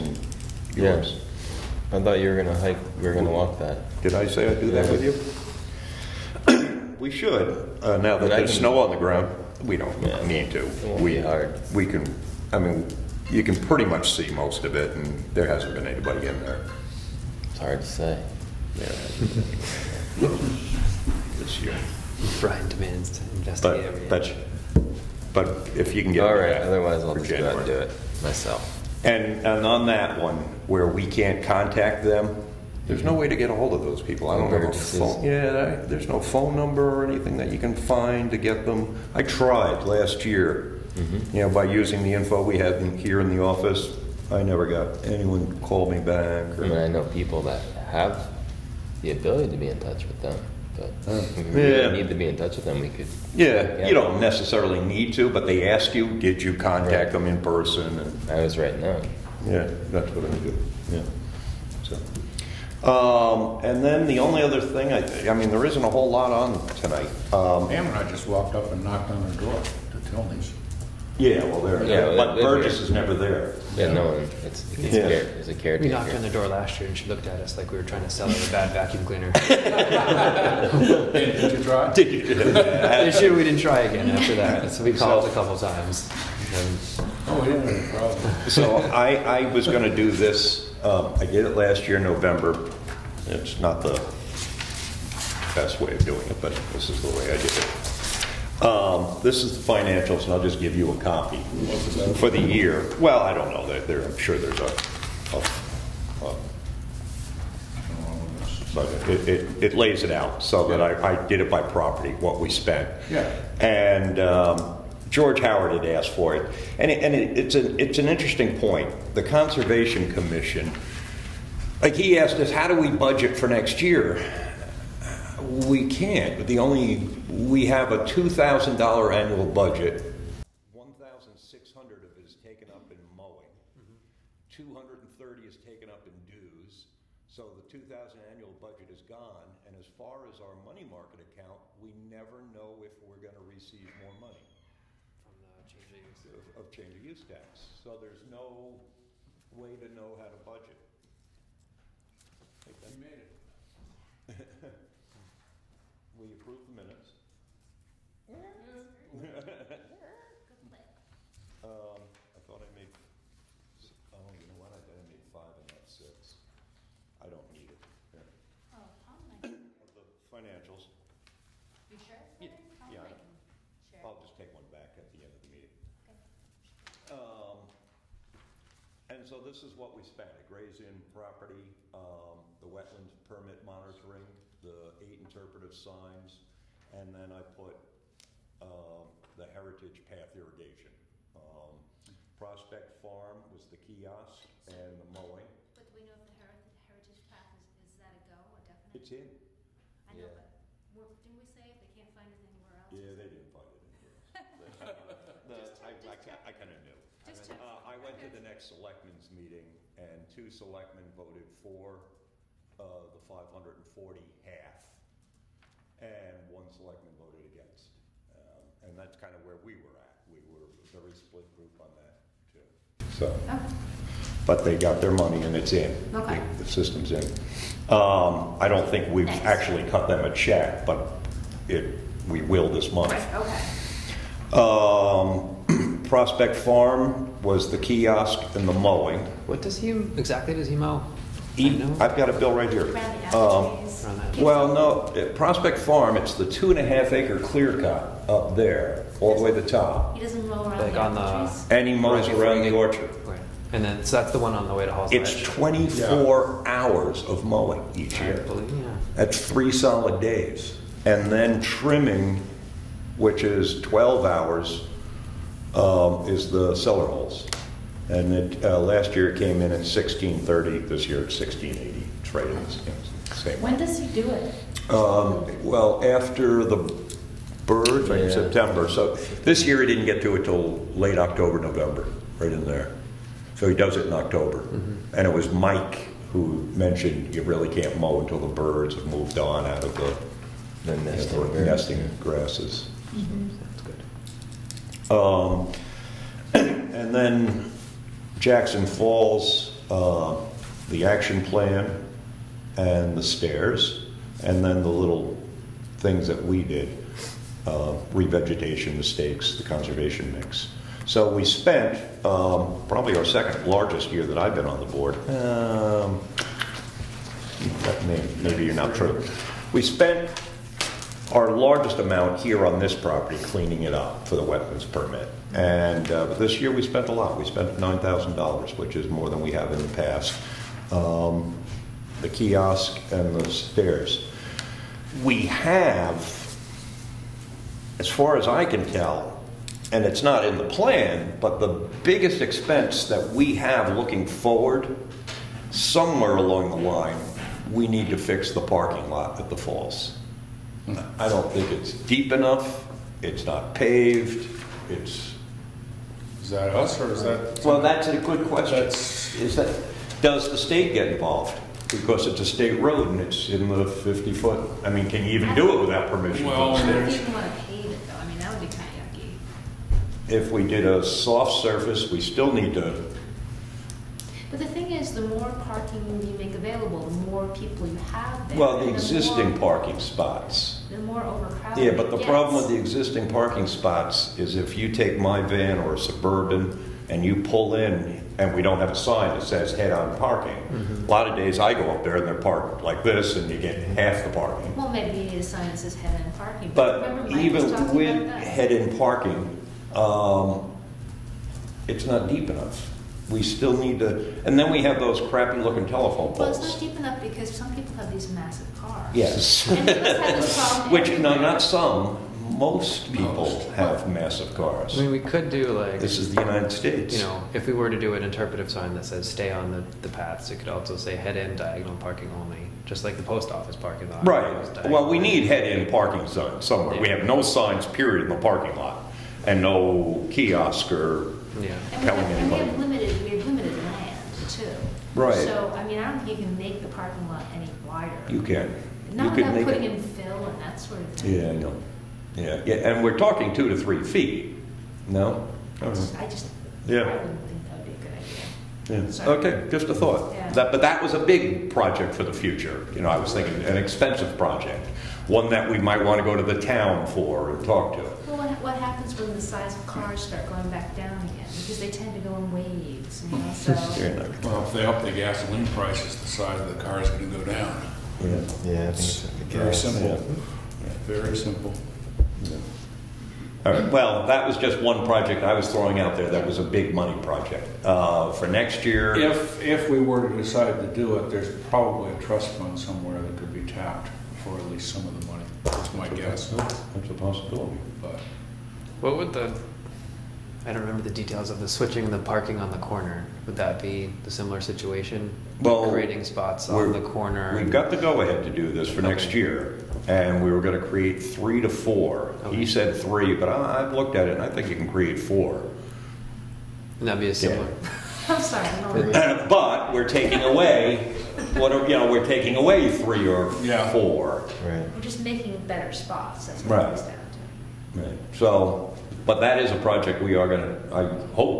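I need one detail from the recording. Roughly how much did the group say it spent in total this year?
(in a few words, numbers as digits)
$9,000.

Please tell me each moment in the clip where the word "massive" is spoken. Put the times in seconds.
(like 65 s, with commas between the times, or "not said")
408 s, 414 s.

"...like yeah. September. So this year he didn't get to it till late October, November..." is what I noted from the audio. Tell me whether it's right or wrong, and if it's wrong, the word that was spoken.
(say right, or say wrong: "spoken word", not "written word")
right.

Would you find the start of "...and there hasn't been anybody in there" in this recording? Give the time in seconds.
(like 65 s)
14 s.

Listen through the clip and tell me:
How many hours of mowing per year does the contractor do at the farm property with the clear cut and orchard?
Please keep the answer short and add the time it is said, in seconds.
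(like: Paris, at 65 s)
24, at 255 s.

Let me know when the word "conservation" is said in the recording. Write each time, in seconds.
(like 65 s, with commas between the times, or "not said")
119 s, 309 s.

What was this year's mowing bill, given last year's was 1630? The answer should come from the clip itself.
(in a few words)
1680.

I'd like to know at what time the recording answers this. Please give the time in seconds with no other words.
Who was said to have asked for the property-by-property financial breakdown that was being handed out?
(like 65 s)
115 s.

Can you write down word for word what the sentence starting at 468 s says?
Yeah, yeah, it's very simple, very simple.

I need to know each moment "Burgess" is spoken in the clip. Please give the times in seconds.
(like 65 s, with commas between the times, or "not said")
72 s.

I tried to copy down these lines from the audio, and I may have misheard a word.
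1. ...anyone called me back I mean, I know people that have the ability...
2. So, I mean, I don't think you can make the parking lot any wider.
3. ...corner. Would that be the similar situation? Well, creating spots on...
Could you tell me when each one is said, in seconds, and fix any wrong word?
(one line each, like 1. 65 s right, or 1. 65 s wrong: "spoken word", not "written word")
1. 45 s right
2. 435 s right
3. 492 s right.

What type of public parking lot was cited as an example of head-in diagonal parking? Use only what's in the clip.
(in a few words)
post office.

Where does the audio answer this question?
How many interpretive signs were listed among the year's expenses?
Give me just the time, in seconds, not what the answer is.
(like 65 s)
184 s.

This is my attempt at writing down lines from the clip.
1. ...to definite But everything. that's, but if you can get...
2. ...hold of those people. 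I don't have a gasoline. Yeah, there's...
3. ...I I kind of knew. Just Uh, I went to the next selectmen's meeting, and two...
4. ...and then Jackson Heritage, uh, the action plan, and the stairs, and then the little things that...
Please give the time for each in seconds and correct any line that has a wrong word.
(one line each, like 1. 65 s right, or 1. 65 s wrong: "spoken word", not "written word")
1. 23 s wrong: "investigate", not "definite"
2. 33 s wrong: "phone", not "gasoline"
3. 205 s right
4. 296 s wrong: "Falls", not "Heritage".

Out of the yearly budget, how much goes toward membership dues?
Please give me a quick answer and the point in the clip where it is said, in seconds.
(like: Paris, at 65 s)
230, at 134 s.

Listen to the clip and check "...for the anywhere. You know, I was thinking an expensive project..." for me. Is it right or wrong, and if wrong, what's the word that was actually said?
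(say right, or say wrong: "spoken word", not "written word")
wrong: "future", not "anywhere".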